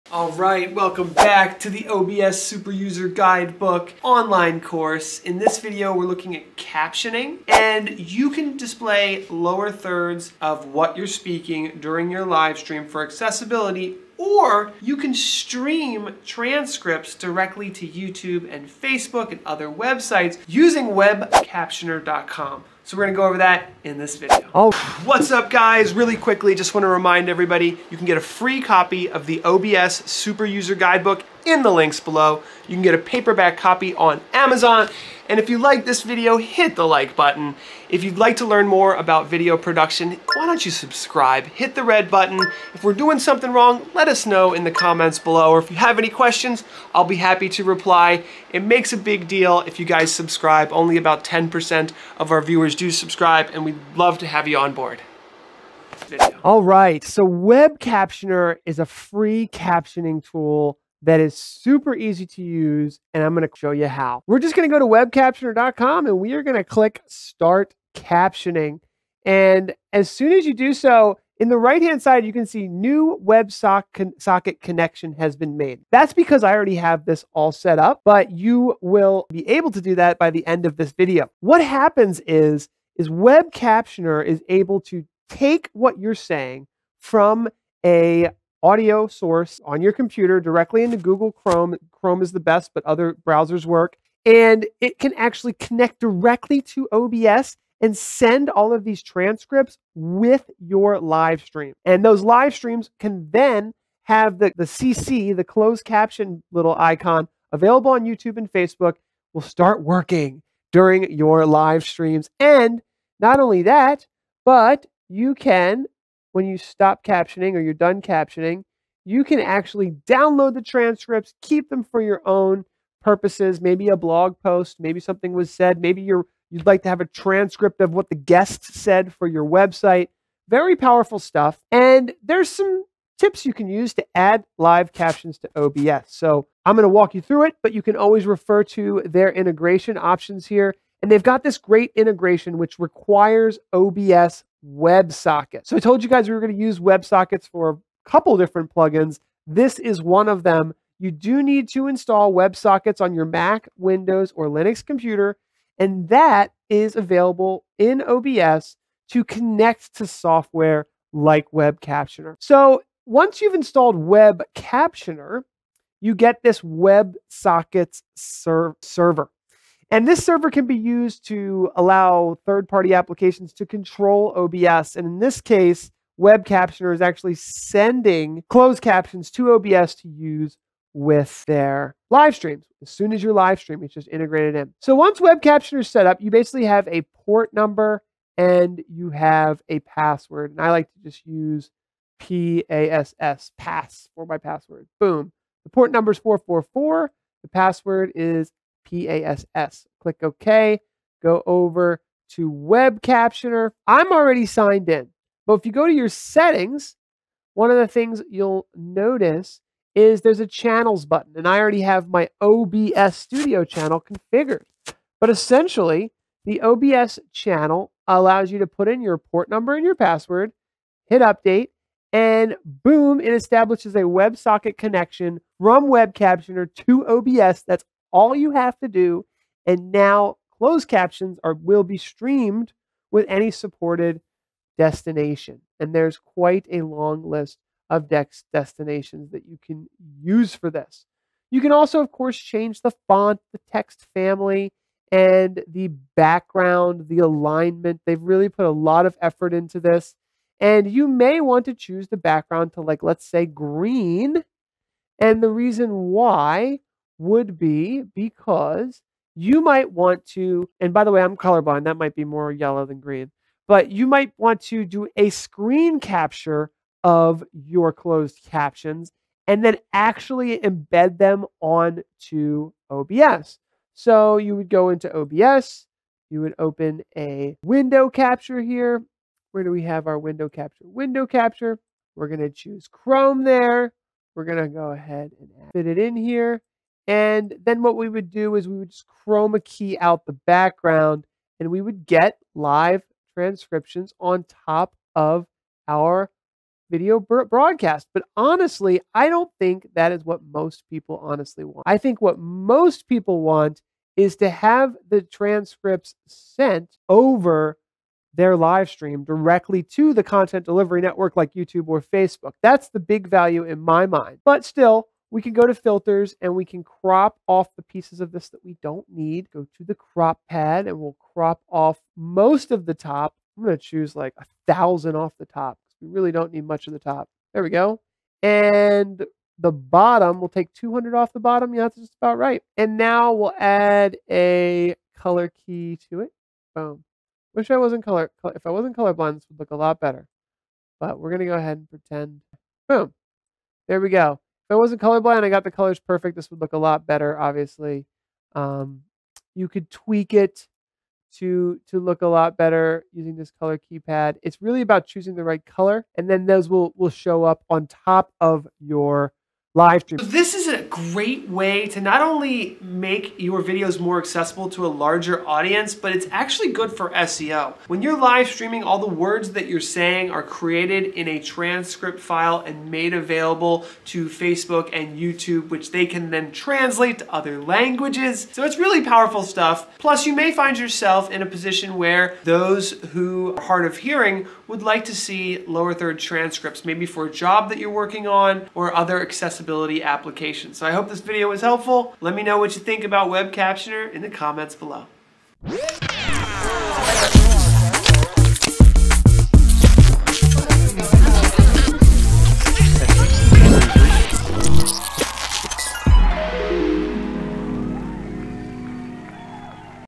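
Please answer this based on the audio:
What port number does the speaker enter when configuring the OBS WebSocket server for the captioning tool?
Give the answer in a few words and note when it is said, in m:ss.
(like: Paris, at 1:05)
444, at 3:16.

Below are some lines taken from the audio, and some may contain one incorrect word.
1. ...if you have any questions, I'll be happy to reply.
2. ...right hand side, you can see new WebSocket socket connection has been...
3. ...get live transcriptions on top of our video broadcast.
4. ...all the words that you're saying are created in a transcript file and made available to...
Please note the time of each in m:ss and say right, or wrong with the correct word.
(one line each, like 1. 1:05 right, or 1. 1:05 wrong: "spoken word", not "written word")
1. 0:45 right
2. 1:11 right
3. 4:52 right
4. 6:08 right.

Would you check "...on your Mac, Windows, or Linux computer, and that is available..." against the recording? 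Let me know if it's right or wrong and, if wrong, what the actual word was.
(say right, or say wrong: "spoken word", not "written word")
right.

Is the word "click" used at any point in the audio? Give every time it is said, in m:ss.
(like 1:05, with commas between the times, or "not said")
1:06, 3:19.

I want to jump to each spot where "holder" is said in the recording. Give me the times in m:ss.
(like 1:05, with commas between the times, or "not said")
not said.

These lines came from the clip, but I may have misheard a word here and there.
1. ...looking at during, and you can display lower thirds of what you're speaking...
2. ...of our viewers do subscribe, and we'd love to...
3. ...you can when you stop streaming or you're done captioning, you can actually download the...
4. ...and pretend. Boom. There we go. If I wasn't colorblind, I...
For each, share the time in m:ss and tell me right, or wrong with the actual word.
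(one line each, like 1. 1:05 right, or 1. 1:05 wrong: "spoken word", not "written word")
1. 0:06 wrong: "captioning", not "during"
2. 0:52 right
3. 1:55 wrong: "captioning", not "streaming"
4. 5:41 right.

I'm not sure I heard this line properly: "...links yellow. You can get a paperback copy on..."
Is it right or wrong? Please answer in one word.
wrong.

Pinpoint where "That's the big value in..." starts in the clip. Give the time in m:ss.
5:12.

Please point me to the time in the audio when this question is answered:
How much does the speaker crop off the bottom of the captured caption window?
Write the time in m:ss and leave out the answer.
5:30.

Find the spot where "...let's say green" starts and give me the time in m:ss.
4:13.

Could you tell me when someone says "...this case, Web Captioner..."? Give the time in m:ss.
2:55.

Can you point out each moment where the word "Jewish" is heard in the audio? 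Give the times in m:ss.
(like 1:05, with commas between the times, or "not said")
not said.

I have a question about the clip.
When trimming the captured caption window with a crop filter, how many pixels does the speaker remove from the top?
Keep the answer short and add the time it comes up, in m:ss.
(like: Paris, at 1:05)
1000, at 5:24.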